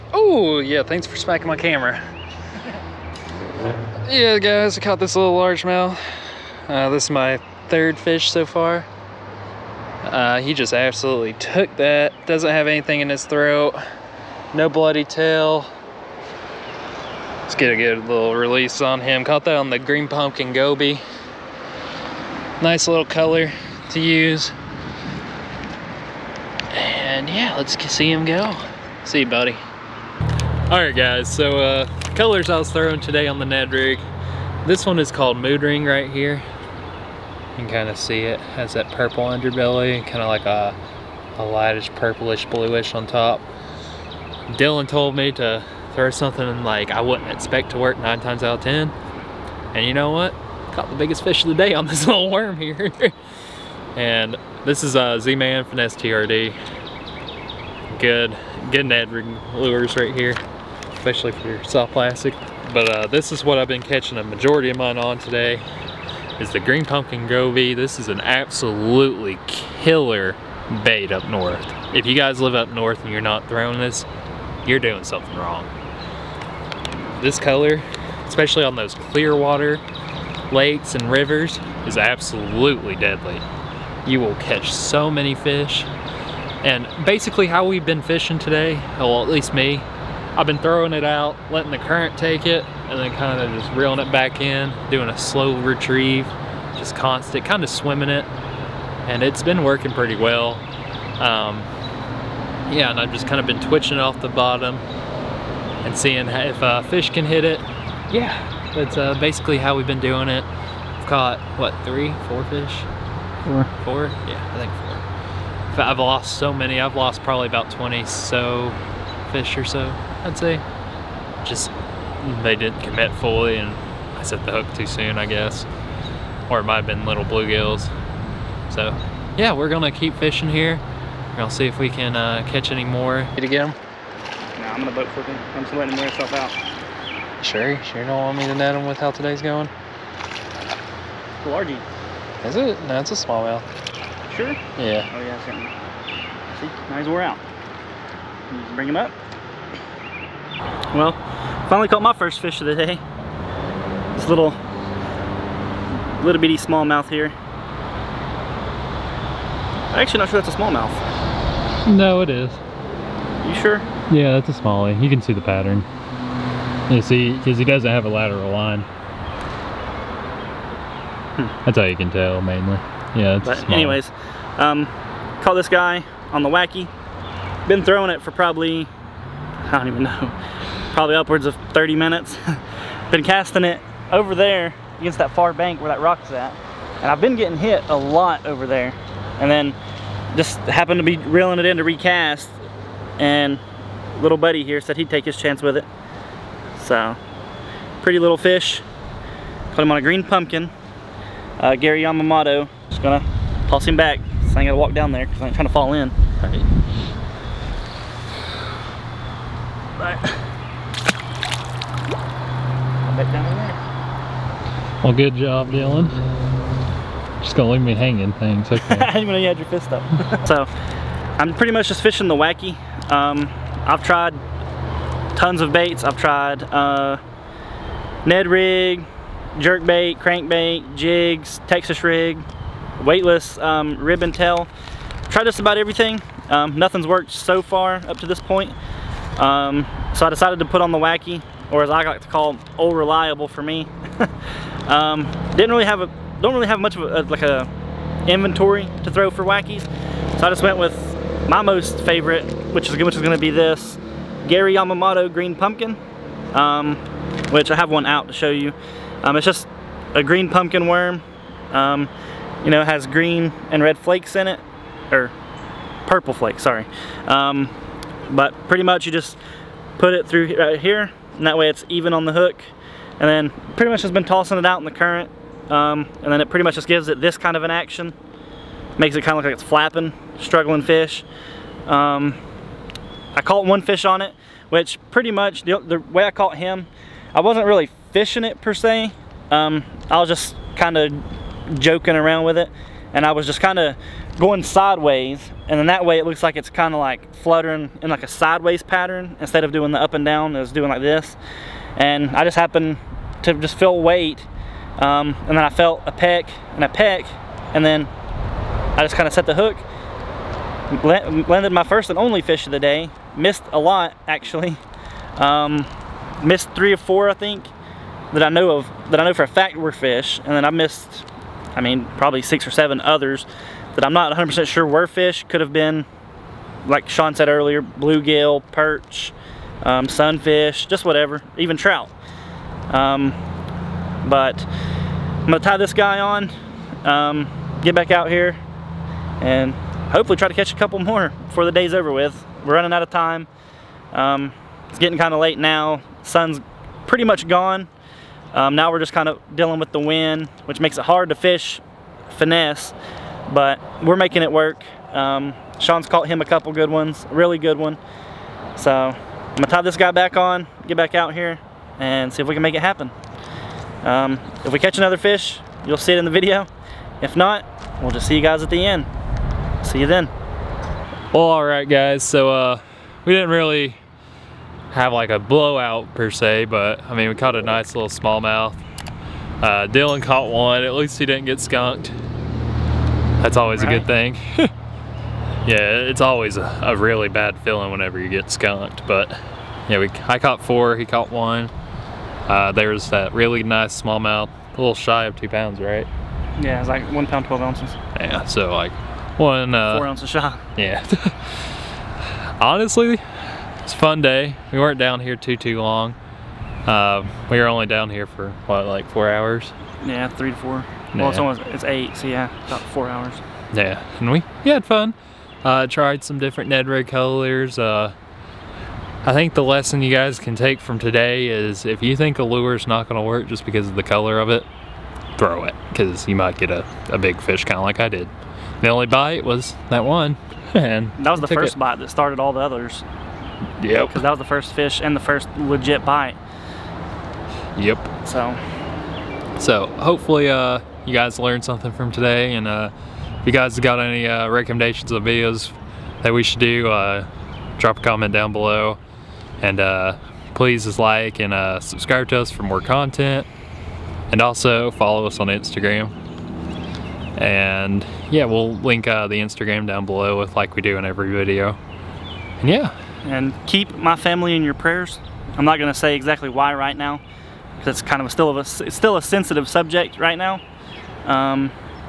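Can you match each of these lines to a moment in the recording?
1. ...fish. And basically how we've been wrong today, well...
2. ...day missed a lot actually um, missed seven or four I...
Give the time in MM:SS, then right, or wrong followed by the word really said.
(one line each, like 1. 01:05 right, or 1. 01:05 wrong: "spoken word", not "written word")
1. 01:25 wrong: "fishing", not "wrong"
2. 05:12 wrong: "three", not "seven".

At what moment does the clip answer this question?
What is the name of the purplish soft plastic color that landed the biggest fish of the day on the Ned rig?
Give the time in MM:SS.
00:35.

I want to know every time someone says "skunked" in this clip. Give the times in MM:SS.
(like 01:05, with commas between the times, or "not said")
06:21, 06:28.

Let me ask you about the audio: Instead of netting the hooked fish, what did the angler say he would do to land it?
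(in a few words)
boat flip him.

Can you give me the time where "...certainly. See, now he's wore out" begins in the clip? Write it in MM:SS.
02:25.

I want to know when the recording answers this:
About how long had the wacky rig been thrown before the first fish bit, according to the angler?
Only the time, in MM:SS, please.
03:01.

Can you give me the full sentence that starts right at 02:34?
This little, little bitty smallmouth here.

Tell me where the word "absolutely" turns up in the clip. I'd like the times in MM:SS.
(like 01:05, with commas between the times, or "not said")
00:10, 01:08, 01:21.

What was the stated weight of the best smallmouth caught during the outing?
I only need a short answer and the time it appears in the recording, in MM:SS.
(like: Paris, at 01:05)
1 pound 12 ounces, at 06:37.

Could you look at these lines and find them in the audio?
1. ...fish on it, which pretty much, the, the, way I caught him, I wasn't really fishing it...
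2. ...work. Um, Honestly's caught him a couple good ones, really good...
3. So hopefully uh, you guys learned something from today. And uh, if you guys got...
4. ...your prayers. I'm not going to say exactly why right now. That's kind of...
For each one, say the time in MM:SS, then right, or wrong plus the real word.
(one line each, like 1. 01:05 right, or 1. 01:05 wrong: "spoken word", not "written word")
1. 04:43 right
2. 05:54 wrong: "Sean", not "Honestly"
3. 07:19 right
4. 07:44 right.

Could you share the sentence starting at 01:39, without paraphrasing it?
And it's been working pretty well.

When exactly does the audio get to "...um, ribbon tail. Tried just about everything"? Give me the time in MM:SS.
03:53.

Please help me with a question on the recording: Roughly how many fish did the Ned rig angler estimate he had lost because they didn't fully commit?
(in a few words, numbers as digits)
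20.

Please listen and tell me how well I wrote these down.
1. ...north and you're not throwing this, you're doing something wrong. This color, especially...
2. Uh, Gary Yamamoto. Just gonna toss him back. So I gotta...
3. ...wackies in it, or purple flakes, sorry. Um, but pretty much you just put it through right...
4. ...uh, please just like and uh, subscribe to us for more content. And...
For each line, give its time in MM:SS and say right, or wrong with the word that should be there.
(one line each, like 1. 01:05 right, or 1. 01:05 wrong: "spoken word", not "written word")
1. 01:12 right
2. 03:21 right
3. 04:23 wrong: "flakes", not "wackies"
4. 07:29 right.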